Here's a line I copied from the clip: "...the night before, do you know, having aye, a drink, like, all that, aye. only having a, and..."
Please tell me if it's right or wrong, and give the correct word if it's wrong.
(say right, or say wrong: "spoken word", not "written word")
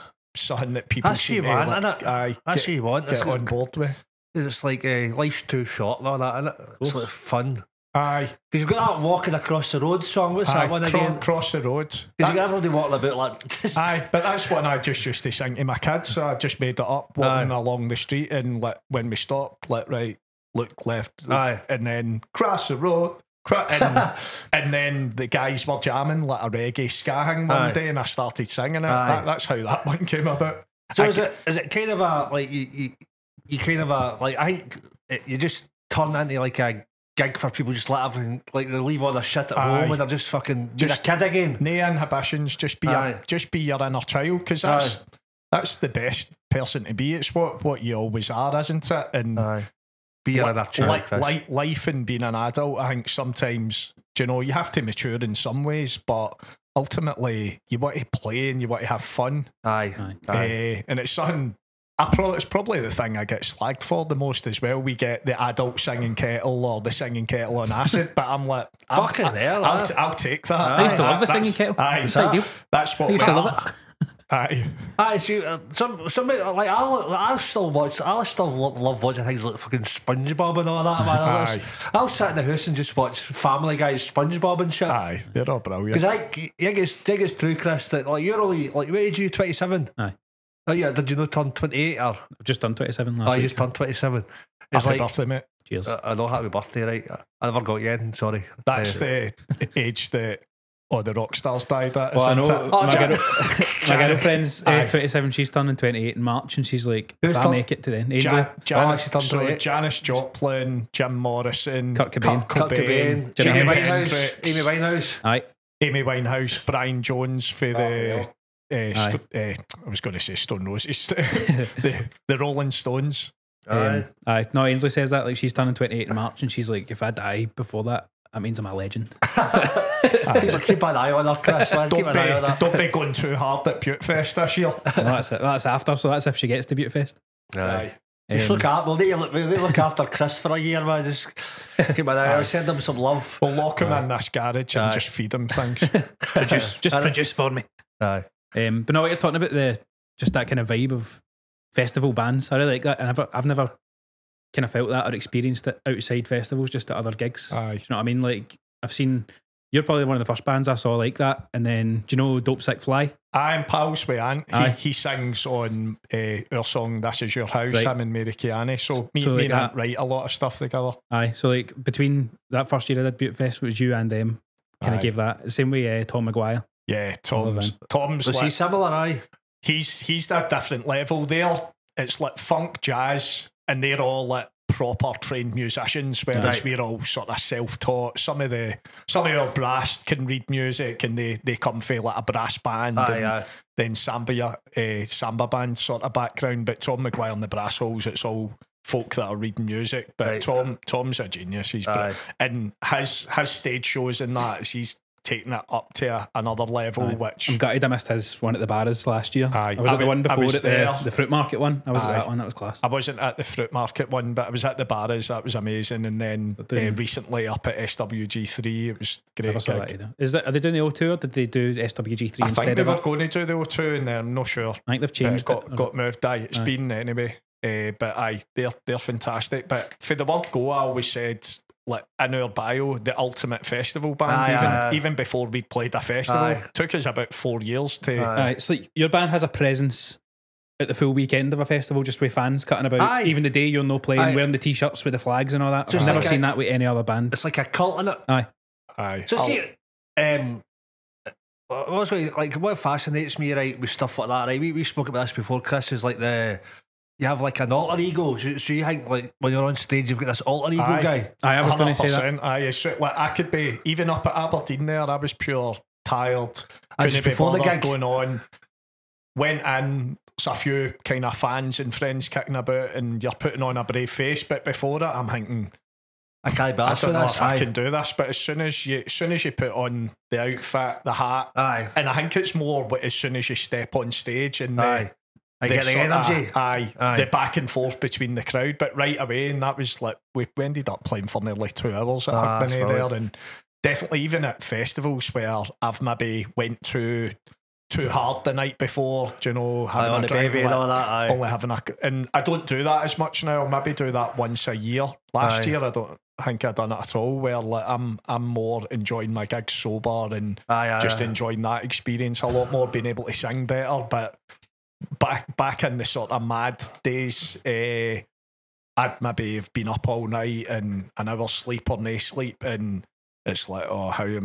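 right.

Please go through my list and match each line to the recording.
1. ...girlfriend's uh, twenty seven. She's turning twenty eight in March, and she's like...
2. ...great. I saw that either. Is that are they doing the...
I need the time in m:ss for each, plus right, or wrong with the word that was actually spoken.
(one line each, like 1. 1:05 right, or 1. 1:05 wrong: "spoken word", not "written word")
1. 1:44 right
2. 3:39 right.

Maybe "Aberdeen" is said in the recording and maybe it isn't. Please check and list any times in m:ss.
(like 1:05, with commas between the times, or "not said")
4:24.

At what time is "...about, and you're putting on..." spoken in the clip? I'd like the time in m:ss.
4:32.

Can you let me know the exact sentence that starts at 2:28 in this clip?
Um, but no, you're talking about the just that kind of vibe of festival bands.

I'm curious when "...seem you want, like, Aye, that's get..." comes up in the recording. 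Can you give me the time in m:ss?
0:01.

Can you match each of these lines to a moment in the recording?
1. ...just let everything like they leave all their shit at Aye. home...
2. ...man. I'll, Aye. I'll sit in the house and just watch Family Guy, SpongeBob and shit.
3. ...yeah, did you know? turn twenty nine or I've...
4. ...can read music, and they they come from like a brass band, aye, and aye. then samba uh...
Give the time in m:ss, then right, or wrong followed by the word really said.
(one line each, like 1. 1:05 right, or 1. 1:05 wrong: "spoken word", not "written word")
1. 0:37 right
2. 1:21 right
3. 1:30 wrong: "eight", not "nine"
4. 3:10 right.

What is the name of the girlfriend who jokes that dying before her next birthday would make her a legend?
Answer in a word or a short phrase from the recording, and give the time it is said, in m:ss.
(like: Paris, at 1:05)
Ainsley, at 2:04.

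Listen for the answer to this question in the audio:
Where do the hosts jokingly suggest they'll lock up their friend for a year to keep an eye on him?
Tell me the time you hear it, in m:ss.
2:24.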